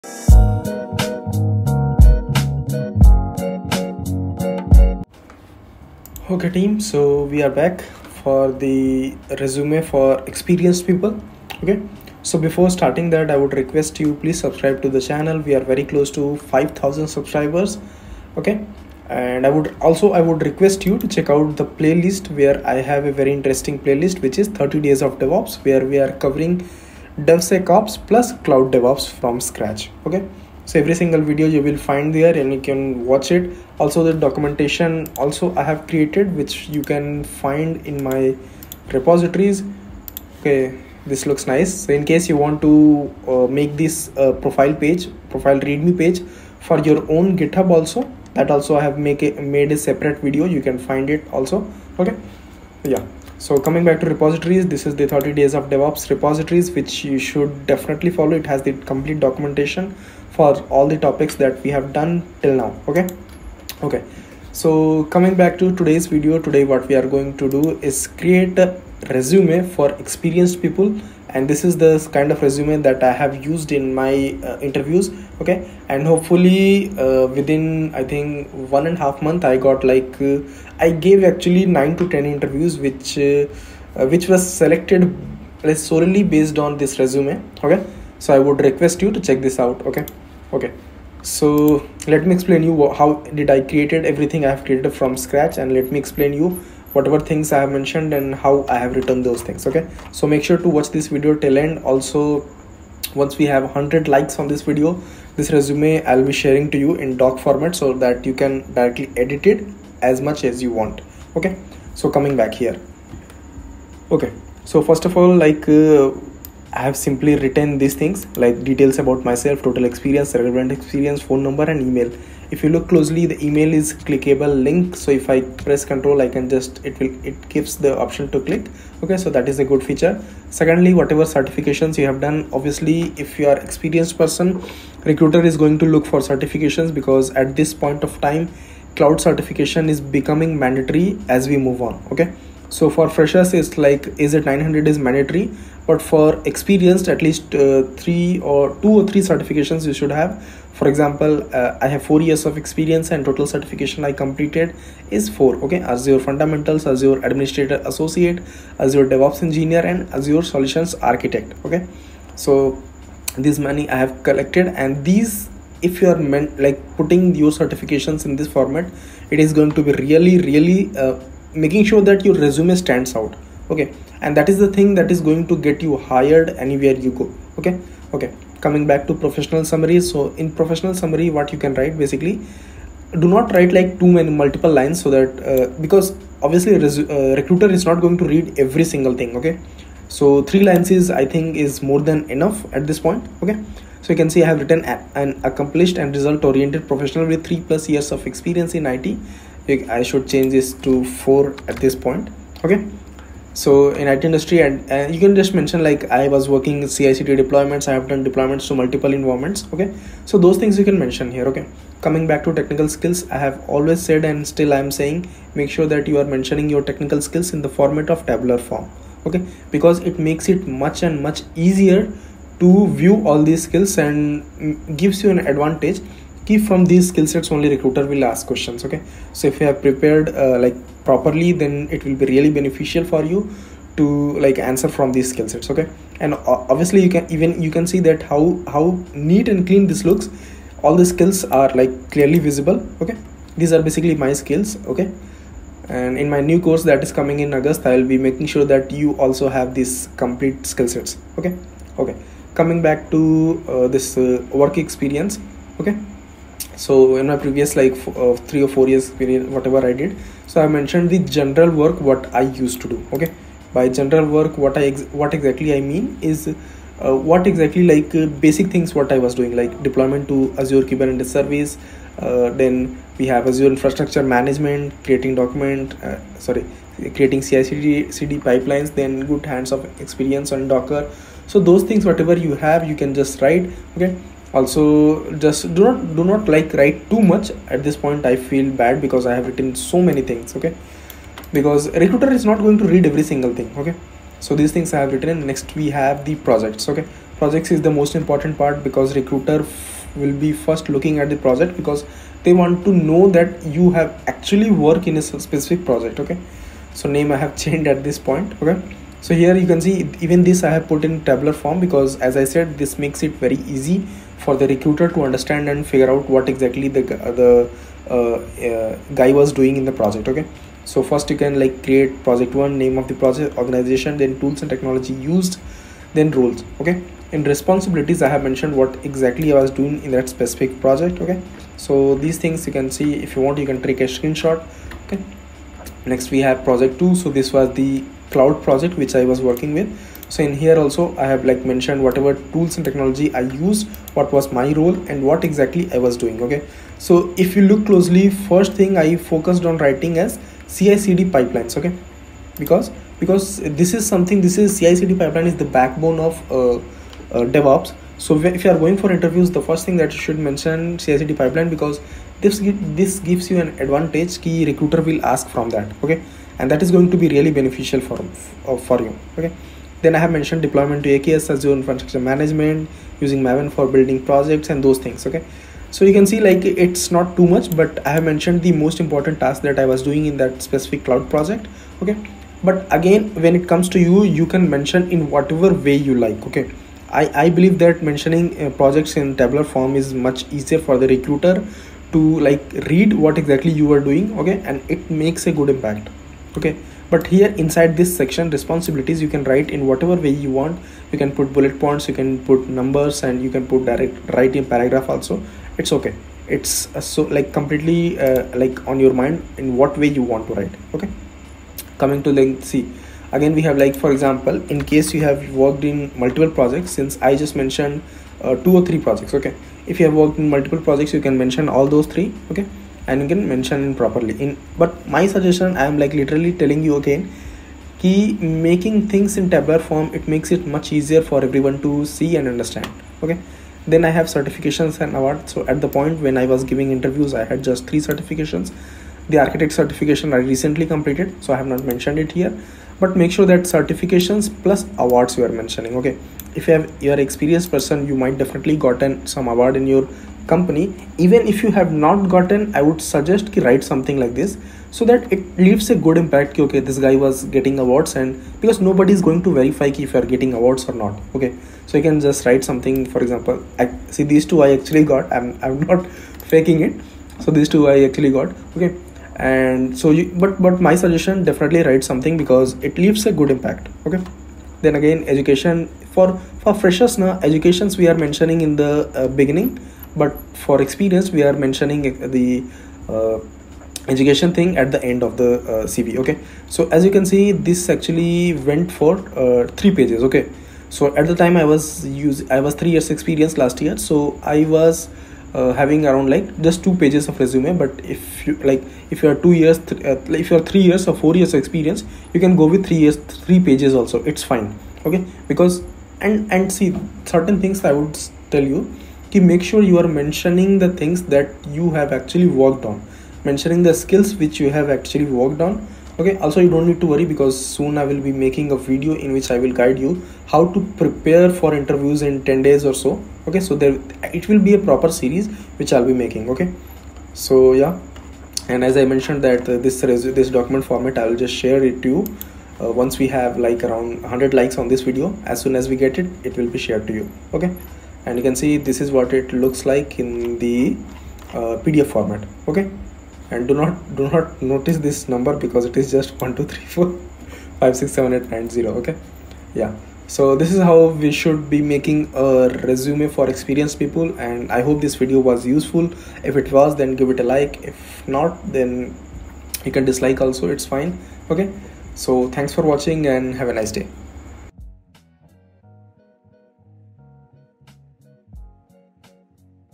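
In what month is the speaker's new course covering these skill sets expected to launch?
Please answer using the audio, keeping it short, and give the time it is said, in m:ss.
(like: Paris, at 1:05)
August, at 4:07.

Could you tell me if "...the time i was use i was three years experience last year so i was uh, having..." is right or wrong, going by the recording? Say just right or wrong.
right.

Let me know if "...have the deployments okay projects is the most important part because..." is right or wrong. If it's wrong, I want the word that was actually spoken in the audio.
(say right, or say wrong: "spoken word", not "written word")
wrong: "projects", not "deployments".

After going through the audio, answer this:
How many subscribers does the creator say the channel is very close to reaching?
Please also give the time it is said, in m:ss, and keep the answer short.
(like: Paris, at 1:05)
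5000, at 0:16.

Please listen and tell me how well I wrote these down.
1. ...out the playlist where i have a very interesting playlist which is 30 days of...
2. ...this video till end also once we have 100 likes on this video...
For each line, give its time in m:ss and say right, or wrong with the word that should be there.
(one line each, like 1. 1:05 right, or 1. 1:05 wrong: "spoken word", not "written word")
1. 0:21 right
2. 1:40 right.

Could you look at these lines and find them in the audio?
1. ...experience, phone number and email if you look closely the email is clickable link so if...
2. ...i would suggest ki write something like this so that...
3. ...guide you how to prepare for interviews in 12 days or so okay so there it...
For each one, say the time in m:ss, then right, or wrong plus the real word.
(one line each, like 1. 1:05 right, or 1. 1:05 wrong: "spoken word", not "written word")
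1. 2:00 right
2. 7:32 right
3. 8:39 wrong: "10", not "12".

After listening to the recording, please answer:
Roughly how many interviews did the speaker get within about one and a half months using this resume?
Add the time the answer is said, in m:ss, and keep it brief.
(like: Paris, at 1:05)
9 to 10, at 1:21.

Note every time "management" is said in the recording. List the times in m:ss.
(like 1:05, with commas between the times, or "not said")
4:34, 6:12.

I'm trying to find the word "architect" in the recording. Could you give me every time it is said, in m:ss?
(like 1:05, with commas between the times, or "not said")
2:41, 7:19.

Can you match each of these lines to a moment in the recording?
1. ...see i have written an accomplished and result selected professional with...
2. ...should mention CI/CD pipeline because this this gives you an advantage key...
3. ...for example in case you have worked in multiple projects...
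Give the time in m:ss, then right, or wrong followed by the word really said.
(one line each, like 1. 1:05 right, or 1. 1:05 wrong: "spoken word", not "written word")
1. 3:14 wrong: "oriented", not "selected"
2. 6:00 right
3. 6:54 right.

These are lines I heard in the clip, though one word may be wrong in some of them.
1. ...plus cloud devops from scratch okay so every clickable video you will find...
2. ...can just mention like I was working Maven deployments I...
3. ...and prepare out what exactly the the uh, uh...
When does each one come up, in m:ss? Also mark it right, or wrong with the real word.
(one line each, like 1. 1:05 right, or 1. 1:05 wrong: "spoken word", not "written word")
1. 0:28 wrong: "single", not "clickable"
2. 3:25 wrong: "CICD", not "Maven"
3. 5:15 wrong: "figure", not "prepare".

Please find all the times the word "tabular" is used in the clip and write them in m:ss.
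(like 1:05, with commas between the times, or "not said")
3:38, 5:11, 6:29, 7:09.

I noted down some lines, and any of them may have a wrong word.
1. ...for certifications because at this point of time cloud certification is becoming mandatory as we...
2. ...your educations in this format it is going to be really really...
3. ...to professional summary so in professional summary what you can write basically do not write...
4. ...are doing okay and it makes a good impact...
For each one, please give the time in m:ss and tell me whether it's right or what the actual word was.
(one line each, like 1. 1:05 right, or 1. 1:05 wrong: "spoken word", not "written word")
1. 2:16 right
2. 2:47 wrong: "certifications", not "educations"
3. 2:59 right
4. 6:33 right.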